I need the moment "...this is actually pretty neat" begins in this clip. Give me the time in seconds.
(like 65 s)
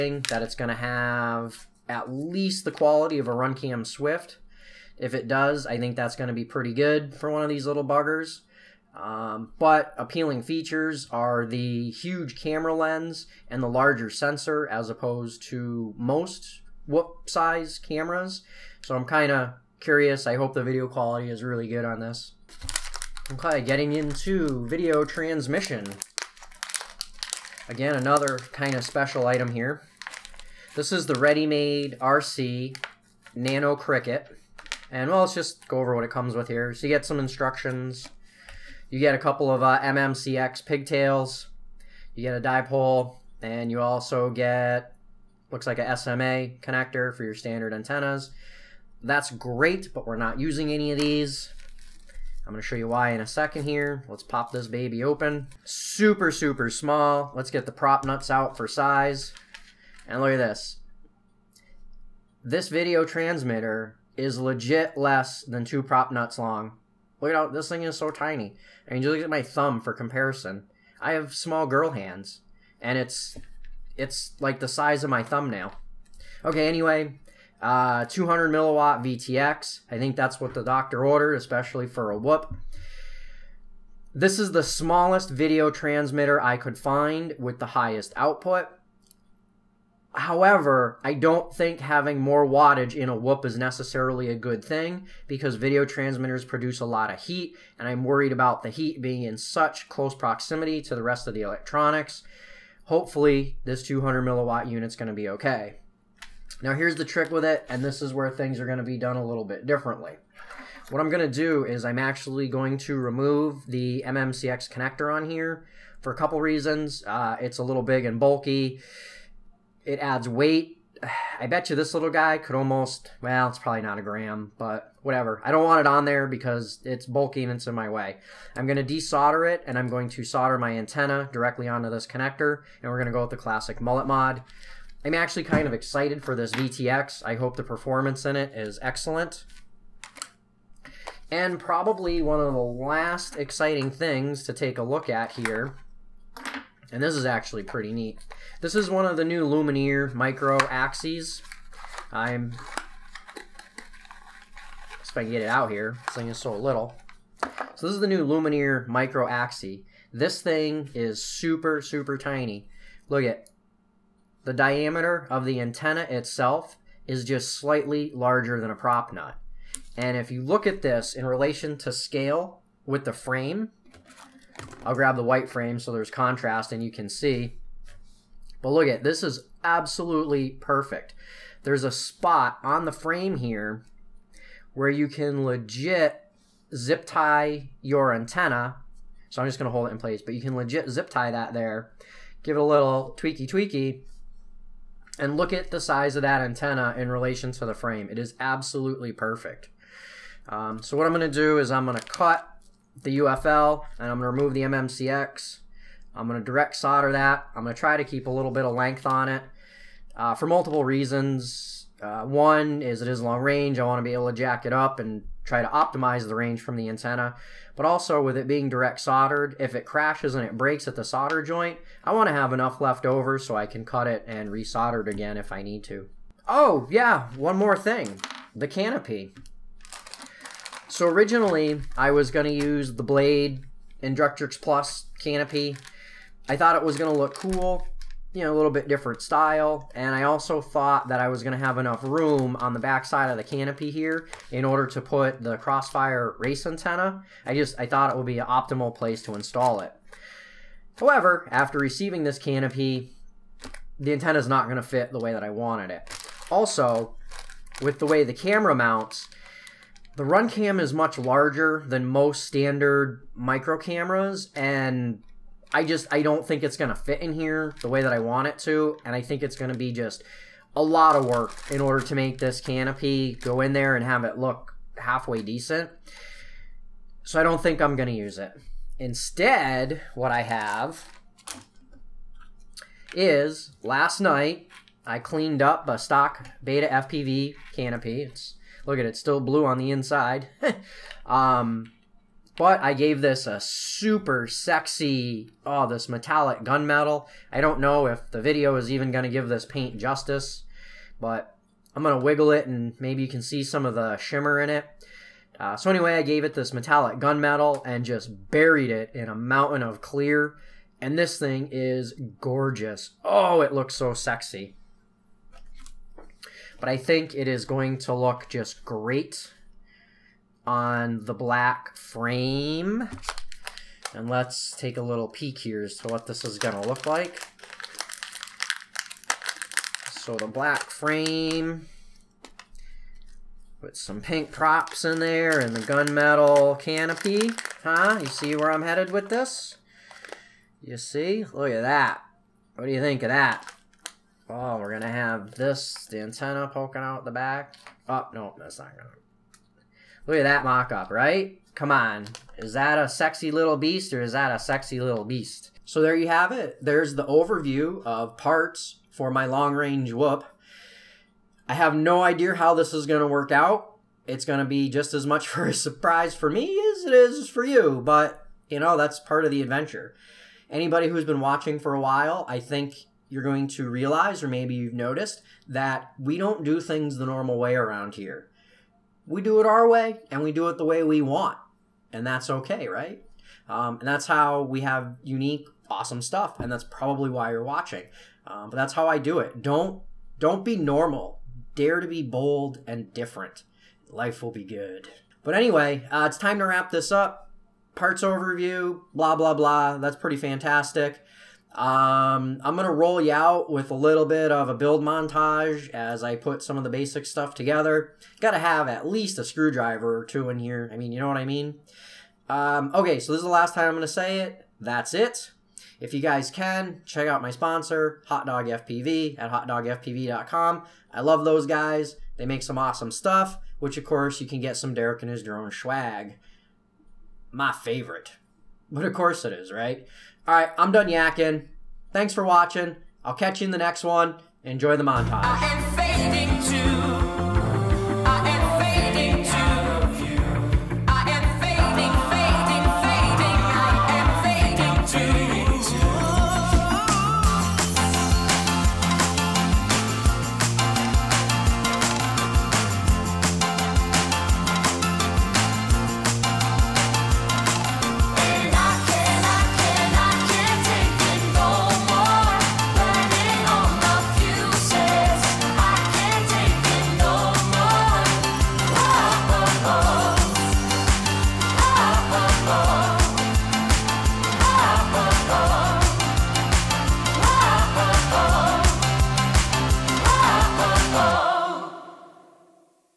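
147 s.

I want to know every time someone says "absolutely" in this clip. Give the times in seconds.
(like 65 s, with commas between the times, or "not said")
179 s, 198 s.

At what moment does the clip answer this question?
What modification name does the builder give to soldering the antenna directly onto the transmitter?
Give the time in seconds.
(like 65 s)
133 s.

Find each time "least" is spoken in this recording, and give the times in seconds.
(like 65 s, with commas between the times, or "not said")
2 s, 409 s.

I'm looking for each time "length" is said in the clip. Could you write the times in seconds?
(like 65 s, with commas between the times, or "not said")
208 s.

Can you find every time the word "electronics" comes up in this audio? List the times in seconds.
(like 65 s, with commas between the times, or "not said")
101 s.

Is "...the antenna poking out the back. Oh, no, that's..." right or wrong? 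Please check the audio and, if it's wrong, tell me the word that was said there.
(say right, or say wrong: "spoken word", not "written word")
right.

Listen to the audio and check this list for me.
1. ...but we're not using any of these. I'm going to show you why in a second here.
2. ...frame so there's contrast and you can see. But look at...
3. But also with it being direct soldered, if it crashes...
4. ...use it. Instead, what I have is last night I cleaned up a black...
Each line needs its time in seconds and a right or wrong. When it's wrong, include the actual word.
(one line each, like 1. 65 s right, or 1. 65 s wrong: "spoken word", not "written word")
1. 49 s right
2. 175 s right
3. 217 s right
4. 278 s wrong: "stock", not "black".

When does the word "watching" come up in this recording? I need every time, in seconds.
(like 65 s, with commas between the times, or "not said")
371 s, 387 s, 432 s.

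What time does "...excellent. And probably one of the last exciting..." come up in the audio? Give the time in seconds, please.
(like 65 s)
138 s.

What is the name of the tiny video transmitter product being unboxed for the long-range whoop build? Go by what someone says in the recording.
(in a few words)
ReadyMadeRC Nano Cricket.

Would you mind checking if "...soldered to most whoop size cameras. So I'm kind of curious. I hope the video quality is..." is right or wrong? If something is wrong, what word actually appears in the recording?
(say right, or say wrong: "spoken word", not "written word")
wrong: "opposed", not "soldered".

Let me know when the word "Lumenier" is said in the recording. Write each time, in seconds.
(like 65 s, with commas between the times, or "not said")
149 s, 158 s.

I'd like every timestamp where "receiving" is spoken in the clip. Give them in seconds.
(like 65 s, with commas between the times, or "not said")
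251 s.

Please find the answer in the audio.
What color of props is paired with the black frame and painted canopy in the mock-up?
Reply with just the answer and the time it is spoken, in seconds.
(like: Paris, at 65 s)
pink, at 334 s.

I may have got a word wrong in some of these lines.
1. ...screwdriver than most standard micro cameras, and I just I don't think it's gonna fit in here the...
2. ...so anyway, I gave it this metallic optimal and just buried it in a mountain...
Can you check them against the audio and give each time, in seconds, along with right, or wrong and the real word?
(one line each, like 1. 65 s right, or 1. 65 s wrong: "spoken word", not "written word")
1. 261 s wrong: "larger", not "screwdriver"
2. 305 s wrong: "gunmetal", not "optimal".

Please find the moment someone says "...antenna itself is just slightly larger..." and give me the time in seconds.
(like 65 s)
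165 s.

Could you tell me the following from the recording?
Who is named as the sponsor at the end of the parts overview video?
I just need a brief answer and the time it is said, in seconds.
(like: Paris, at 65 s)
Hot Dog FPV, at 418 s.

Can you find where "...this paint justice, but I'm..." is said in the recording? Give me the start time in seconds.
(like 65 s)
299 s.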